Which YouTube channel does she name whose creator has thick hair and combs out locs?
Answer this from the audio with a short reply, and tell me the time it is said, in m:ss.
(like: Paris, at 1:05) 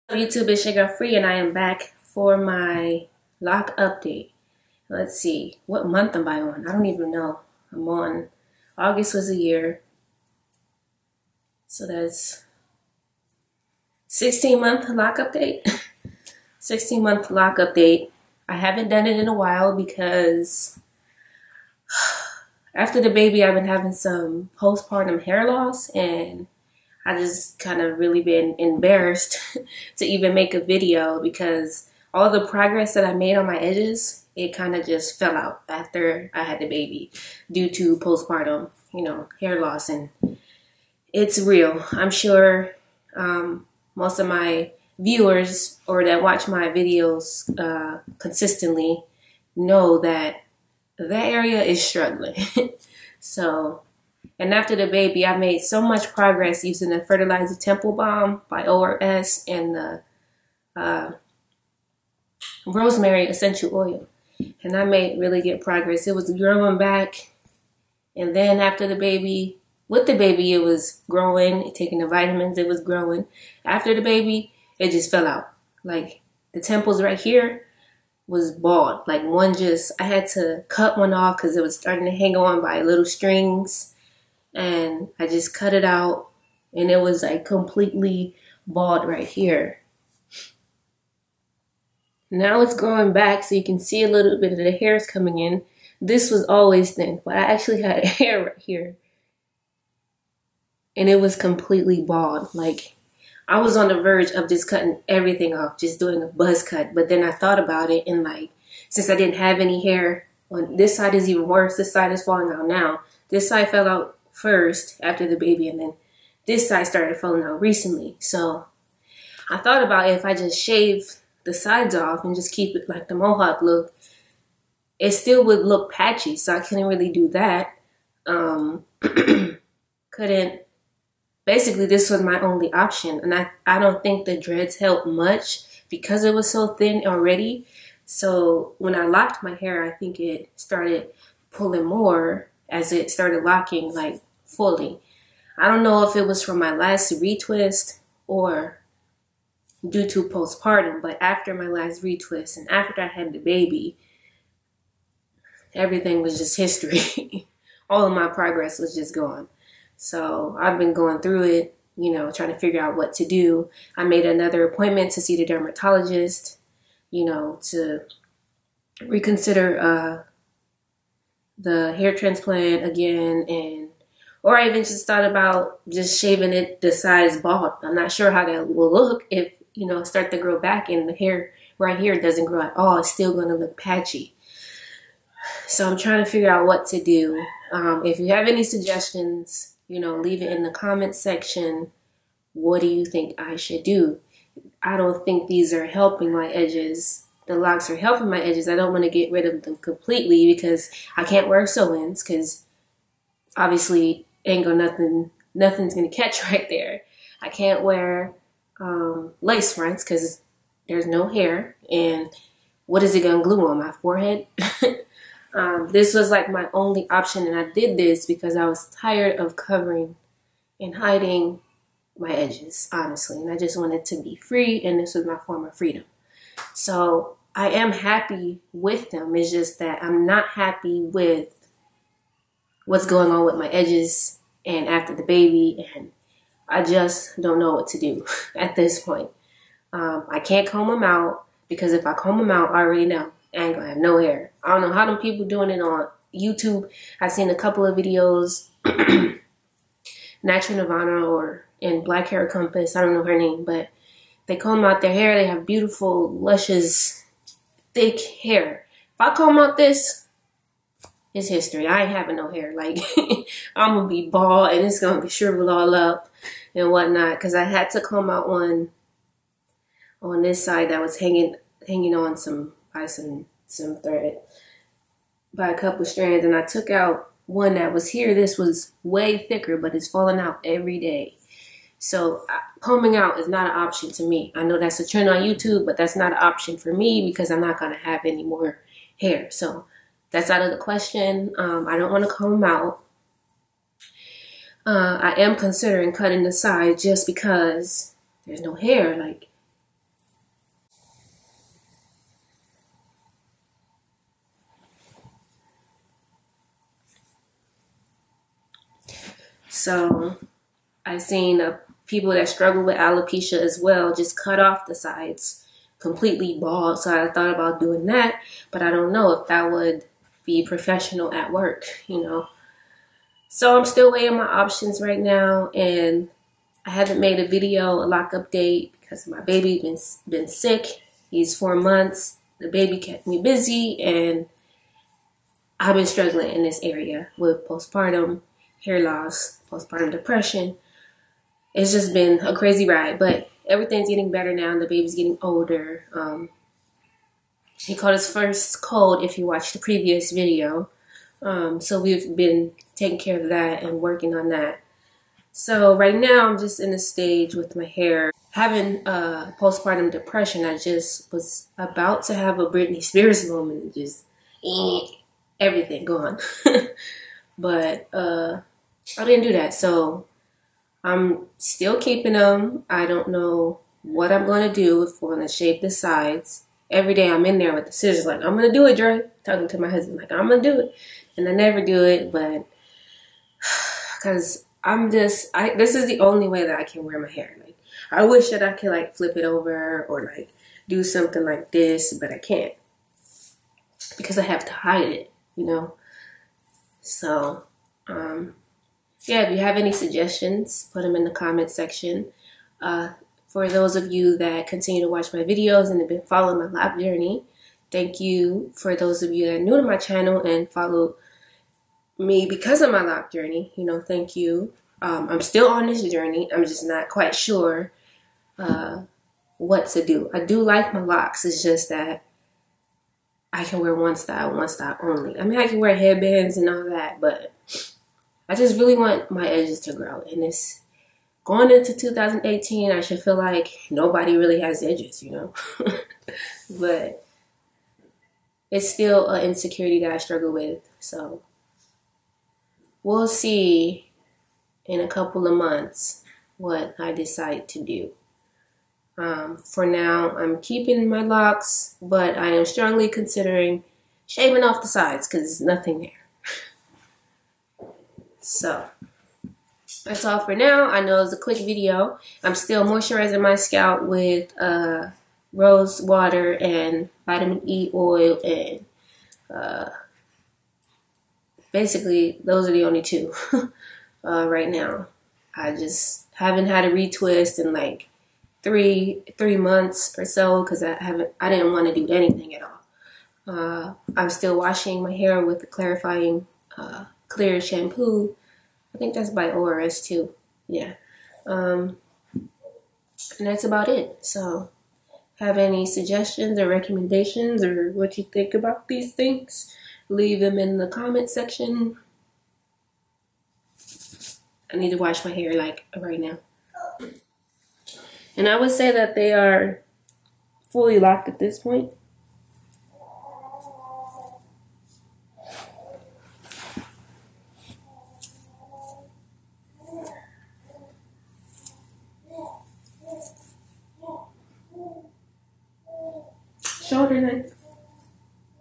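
Natural Nirvana, at 4:10.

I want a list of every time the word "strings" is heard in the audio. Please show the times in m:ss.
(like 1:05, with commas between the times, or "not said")
1:23.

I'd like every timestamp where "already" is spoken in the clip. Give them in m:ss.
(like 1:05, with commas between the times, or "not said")
2:17, 4:02.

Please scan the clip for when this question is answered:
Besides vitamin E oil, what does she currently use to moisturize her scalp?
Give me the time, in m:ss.
7:45.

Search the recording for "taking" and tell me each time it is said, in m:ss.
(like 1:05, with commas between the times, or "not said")
1:11, 5:52.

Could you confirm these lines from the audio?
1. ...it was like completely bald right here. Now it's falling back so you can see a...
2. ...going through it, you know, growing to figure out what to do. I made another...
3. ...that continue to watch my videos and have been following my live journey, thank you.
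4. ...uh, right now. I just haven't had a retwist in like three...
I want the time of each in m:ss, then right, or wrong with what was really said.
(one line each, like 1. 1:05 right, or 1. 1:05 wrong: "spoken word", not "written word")
1. 1:26 wrong: "growing", not "falling"
2. 2:40 wrong: "trying", not "growing"
3. 6:44 right
4. 7:54 right.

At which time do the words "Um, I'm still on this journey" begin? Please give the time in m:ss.
6:55.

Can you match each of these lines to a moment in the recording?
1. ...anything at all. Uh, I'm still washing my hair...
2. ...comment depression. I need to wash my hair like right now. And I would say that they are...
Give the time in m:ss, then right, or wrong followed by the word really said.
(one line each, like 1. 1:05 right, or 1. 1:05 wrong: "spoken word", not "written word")
1. 8:02 right
2. 8:20 wrong: "section", not "depression".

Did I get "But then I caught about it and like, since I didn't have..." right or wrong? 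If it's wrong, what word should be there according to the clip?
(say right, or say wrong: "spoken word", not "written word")
wrong: "thought", not "caught".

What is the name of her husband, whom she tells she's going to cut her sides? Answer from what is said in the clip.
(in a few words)
Dre.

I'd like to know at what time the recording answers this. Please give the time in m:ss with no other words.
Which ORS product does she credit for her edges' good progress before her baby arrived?
0:57.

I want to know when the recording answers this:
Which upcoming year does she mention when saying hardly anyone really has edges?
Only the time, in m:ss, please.
7:11.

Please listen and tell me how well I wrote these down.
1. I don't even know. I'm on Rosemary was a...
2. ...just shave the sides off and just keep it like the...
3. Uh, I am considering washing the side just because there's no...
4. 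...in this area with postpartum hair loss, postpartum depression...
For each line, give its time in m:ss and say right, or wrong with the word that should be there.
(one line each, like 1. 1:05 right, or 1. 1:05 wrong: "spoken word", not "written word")
1. 0:06 wrong: "August", not "Rosemary"
2. 2:00 right
3. 4:54 wrong: "cutting", not "washing"
4. 5:36 right.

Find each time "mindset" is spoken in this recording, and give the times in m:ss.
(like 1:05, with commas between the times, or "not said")
not said.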